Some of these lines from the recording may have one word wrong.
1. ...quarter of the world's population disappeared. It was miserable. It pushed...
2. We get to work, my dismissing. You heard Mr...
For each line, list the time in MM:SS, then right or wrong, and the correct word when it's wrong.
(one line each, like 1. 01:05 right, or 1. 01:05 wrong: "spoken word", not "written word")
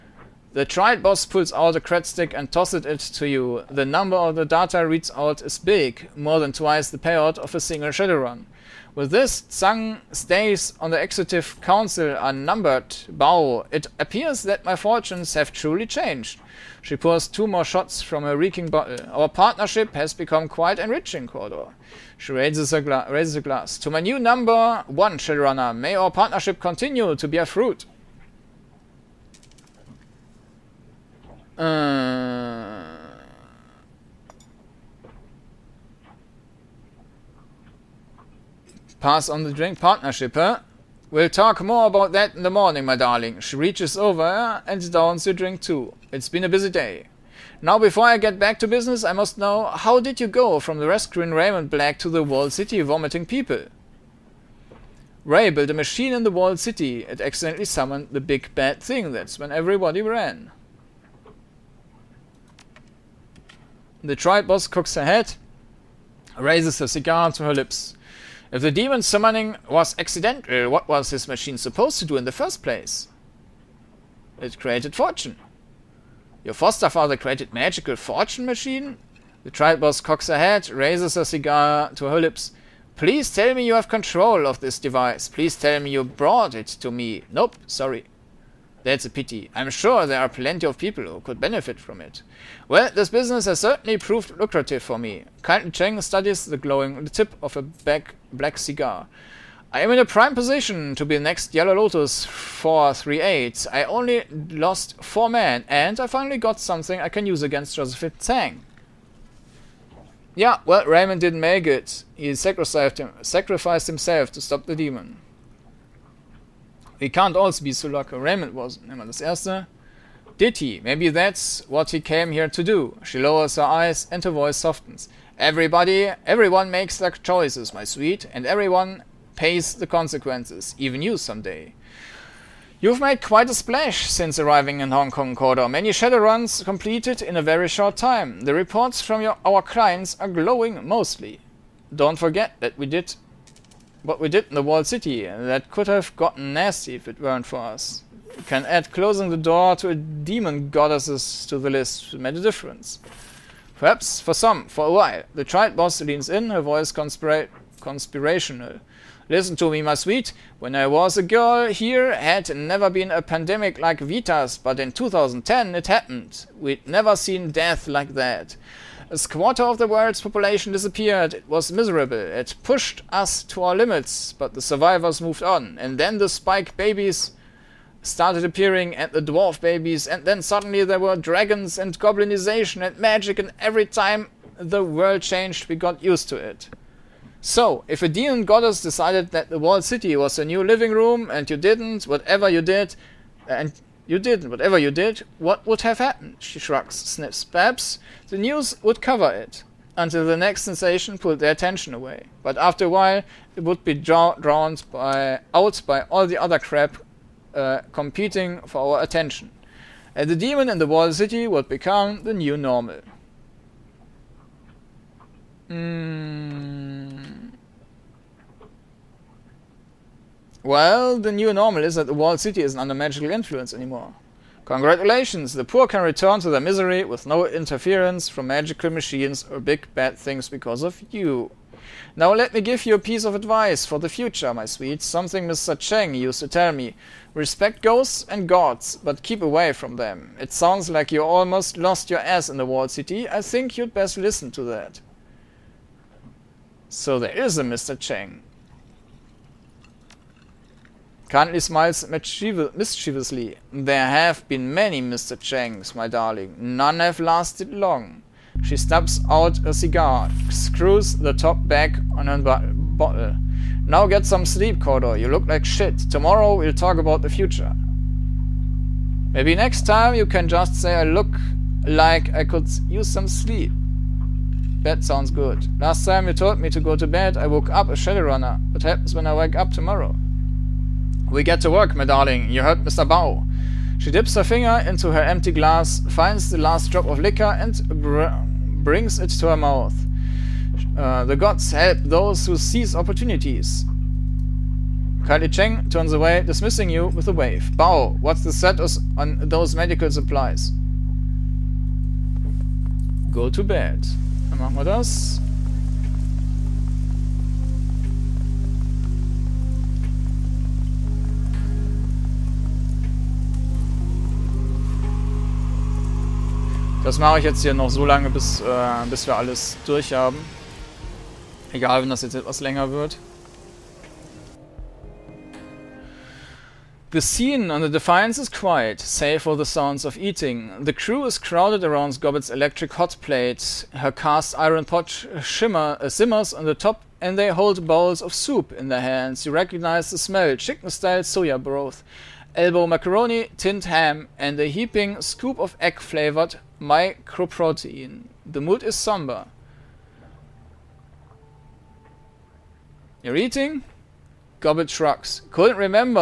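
1. 02:49 right
2. 04:41 wrong: "darling", not "dismissing".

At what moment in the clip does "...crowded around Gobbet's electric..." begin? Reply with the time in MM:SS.
05:31.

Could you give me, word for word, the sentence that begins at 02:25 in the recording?
That could have gotten nasty if it weren't for us.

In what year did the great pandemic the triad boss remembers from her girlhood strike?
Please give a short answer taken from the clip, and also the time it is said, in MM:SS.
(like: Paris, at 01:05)
2010, at 02:44.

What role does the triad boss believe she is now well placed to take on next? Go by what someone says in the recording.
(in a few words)
Yellow Lotus 438.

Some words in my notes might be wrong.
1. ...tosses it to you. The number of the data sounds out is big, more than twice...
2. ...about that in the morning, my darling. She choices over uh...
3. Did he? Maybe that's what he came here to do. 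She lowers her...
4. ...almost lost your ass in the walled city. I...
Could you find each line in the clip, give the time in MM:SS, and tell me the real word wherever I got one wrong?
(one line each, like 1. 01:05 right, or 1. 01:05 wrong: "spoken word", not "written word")
1. 00:02 wrong: "reads", not "sounds"
2. 00:41 wrong: "reaches", not "choices"
3. 02:00 right
4. 04:01 right.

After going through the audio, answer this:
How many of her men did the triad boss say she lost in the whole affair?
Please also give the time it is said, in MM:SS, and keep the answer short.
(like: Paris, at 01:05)
4, at 01:45.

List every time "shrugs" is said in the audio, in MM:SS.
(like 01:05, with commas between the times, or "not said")
03:16, 05:54.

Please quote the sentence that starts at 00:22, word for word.
She raises a, raises a glass.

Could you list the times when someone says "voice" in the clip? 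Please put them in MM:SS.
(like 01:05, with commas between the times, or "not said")
02:04, 02:36.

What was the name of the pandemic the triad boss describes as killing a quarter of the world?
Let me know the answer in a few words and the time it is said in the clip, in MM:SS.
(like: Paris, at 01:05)
VITAS, at 02:43.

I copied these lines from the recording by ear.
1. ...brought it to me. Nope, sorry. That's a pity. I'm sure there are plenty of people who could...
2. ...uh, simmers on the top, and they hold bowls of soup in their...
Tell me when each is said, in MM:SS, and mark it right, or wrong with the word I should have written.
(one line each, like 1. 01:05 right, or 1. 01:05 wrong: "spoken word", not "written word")
1. 01:26 right
2. 05:36 right.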